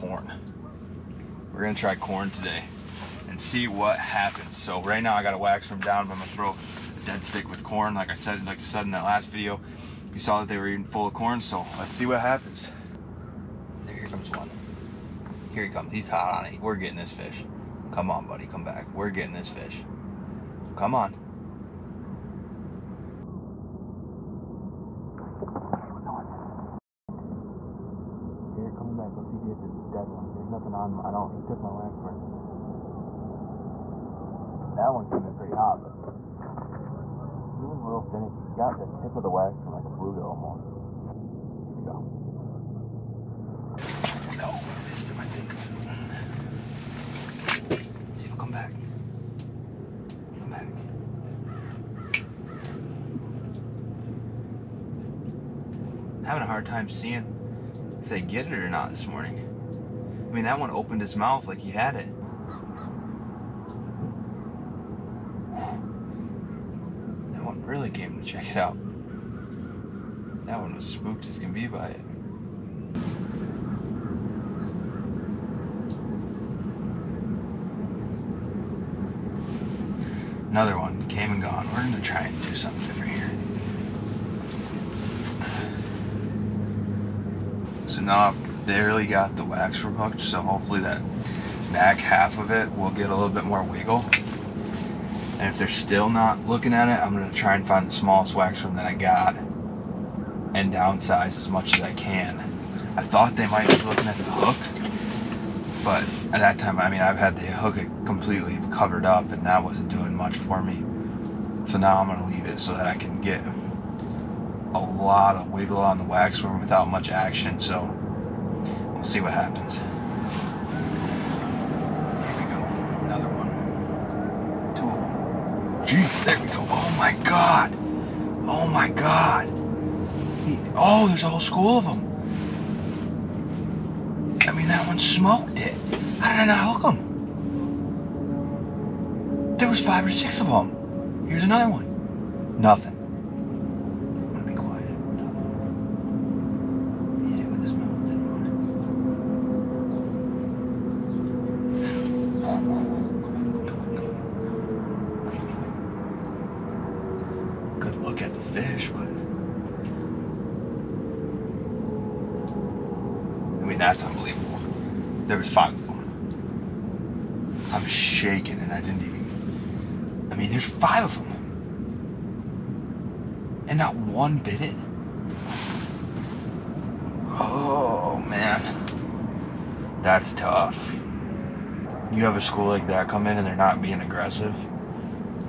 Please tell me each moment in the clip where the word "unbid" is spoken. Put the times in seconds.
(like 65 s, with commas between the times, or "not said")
174 s.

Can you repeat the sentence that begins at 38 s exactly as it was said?
He got the tip of the wax worm like a bluegill almost.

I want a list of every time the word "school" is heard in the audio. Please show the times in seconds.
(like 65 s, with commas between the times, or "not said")
131 s, 182 s.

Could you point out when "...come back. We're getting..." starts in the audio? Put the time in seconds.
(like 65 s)
18 s.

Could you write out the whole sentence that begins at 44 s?
No, I missed him, I think.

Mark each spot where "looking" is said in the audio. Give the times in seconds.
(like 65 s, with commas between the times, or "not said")
96 s, 103 s.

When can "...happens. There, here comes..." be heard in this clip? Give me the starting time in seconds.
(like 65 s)
12 s.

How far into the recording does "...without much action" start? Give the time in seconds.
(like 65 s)
116 s.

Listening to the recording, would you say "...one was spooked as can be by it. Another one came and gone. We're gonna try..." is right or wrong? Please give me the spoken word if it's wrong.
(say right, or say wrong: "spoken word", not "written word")
right.